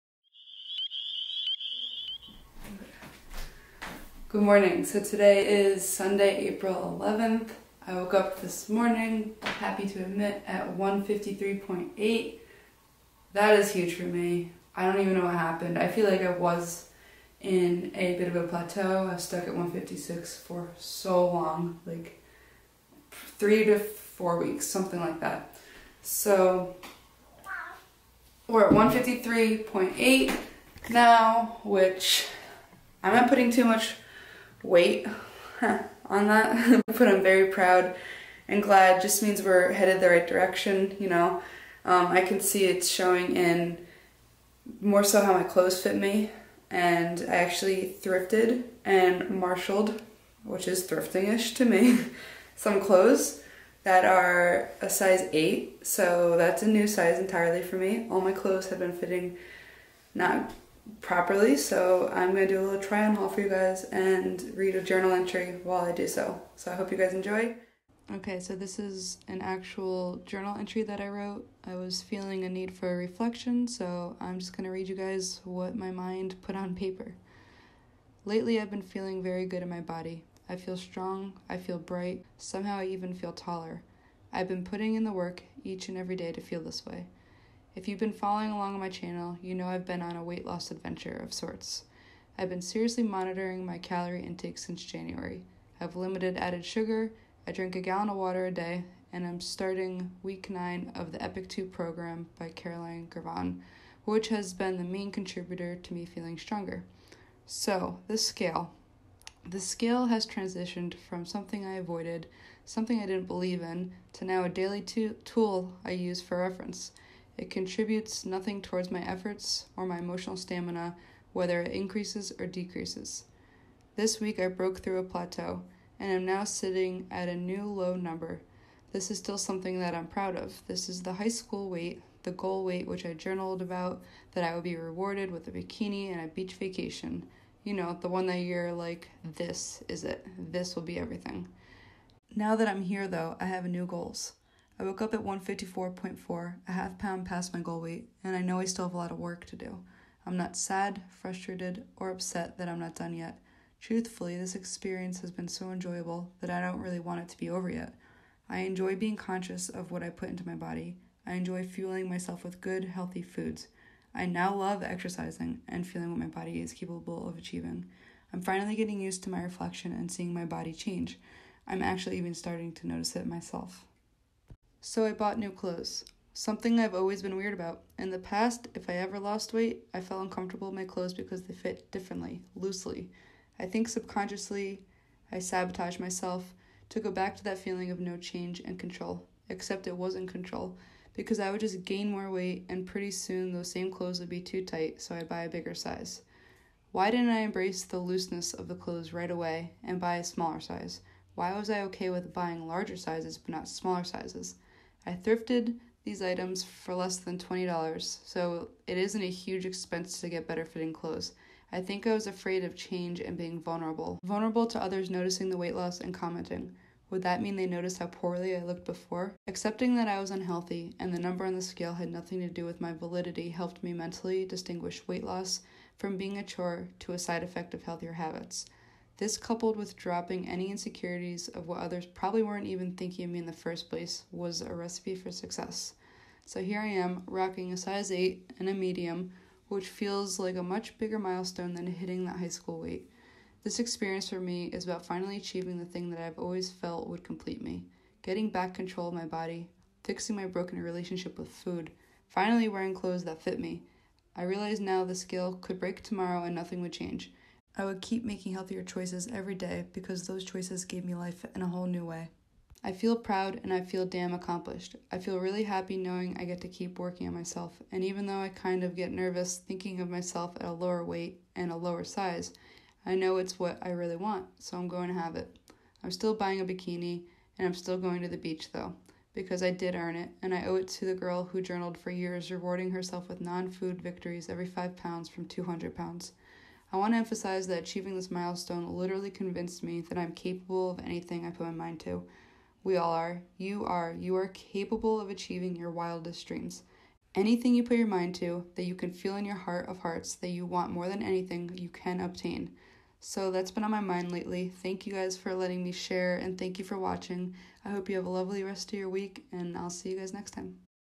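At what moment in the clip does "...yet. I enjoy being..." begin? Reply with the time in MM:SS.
02:37.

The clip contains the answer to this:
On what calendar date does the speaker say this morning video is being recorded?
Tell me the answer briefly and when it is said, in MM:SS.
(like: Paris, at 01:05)
April 11th, at 00:06.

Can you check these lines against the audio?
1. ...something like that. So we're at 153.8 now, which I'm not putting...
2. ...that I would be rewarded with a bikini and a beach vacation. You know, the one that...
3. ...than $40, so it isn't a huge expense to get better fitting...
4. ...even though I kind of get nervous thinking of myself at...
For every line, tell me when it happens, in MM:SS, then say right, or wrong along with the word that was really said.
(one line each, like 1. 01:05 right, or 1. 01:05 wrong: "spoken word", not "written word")
1. 00:24 right
2. 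02:14 right
3. 03:27 wrong: "20", not "40"
4. 04:28 right.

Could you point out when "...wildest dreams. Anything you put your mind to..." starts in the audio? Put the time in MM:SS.
04:55.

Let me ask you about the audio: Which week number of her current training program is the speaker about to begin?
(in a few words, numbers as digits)
9.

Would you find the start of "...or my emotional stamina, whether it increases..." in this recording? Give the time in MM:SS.
01:59.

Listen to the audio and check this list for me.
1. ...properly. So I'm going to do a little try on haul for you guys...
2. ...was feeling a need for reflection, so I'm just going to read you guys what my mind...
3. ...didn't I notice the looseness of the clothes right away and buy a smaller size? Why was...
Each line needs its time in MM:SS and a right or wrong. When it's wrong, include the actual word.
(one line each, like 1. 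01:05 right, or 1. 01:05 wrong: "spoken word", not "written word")
1. 01:01 right
2. 01:11 right
3. 03:17 wrong: "embrace", not "notice".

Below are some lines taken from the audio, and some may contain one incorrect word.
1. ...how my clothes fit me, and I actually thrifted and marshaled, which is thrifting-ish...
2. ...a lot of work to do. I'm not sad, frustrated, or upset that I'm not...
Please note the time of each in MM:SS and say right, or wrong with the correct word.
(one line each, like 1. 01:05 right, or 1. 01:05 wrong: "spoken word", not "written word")
1. 00:45 right
2. 02:28 right.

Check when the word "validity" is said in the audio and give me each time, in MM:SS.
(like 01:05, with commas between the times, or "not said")
03:42.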